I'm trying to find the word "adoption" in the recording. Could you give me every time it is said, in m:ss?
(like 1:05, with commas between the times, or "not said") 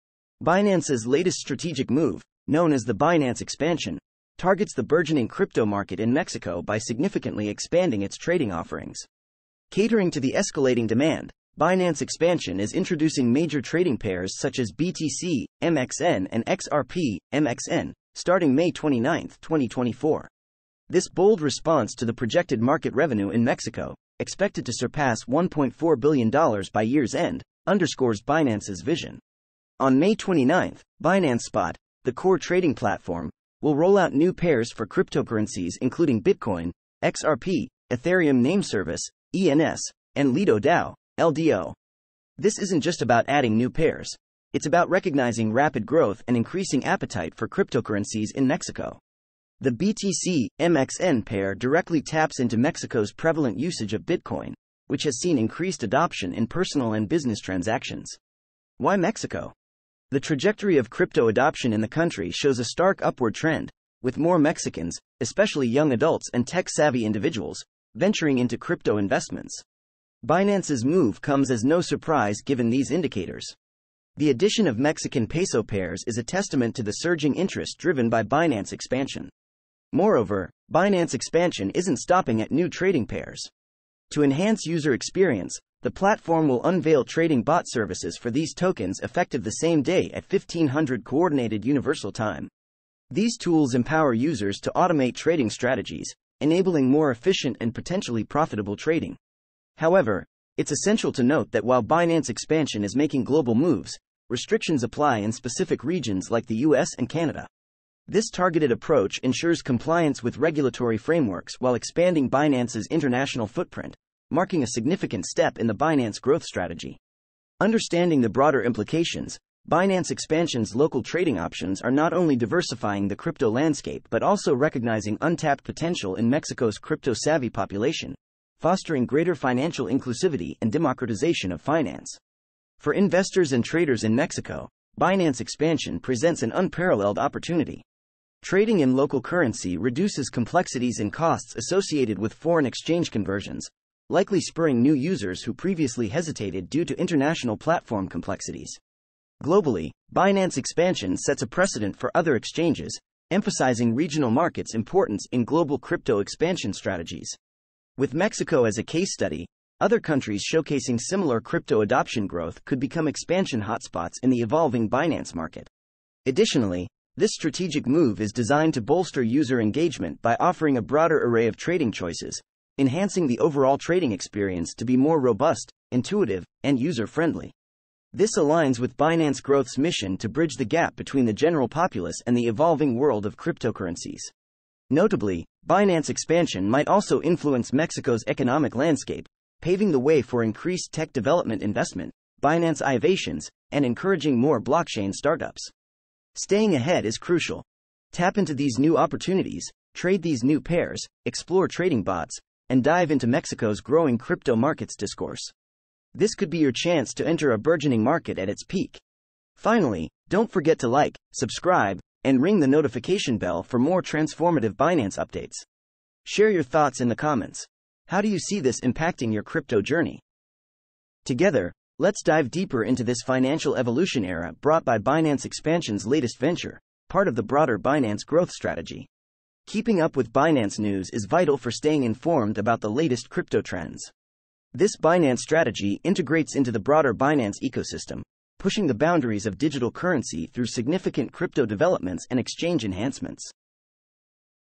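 0:55, 1:01, 2:41.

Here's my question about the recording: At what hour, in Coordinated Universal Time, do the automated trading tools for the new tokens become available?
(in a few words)
1500.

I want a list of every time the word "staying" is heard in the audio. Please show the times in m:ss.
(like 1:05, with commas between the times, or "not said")
3:16, 3:51.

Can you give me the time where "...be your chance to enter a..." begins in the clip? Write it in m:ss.
3:26.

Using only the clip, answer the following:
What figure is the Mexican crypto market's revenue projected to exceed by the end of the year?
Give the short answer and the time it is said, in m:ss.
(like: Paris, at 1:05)
$1.4 billion, at 0:25.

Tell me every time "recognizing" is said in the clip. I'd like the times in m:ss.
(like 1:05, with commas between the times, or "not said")
0:44, 2:04.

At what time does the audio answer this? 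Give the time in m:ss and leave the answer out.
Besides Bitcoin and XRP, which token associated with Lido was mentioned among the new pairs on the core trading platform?
0:41.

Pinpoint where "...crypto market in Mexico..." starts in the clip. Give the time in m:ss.
0:05.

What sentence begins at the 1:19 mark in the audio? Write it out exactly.
Moreover, Binance expansion isn't stopping at new trading pairs.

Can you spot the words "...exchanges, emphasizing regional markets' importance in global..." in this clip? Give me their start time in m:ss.
2:32.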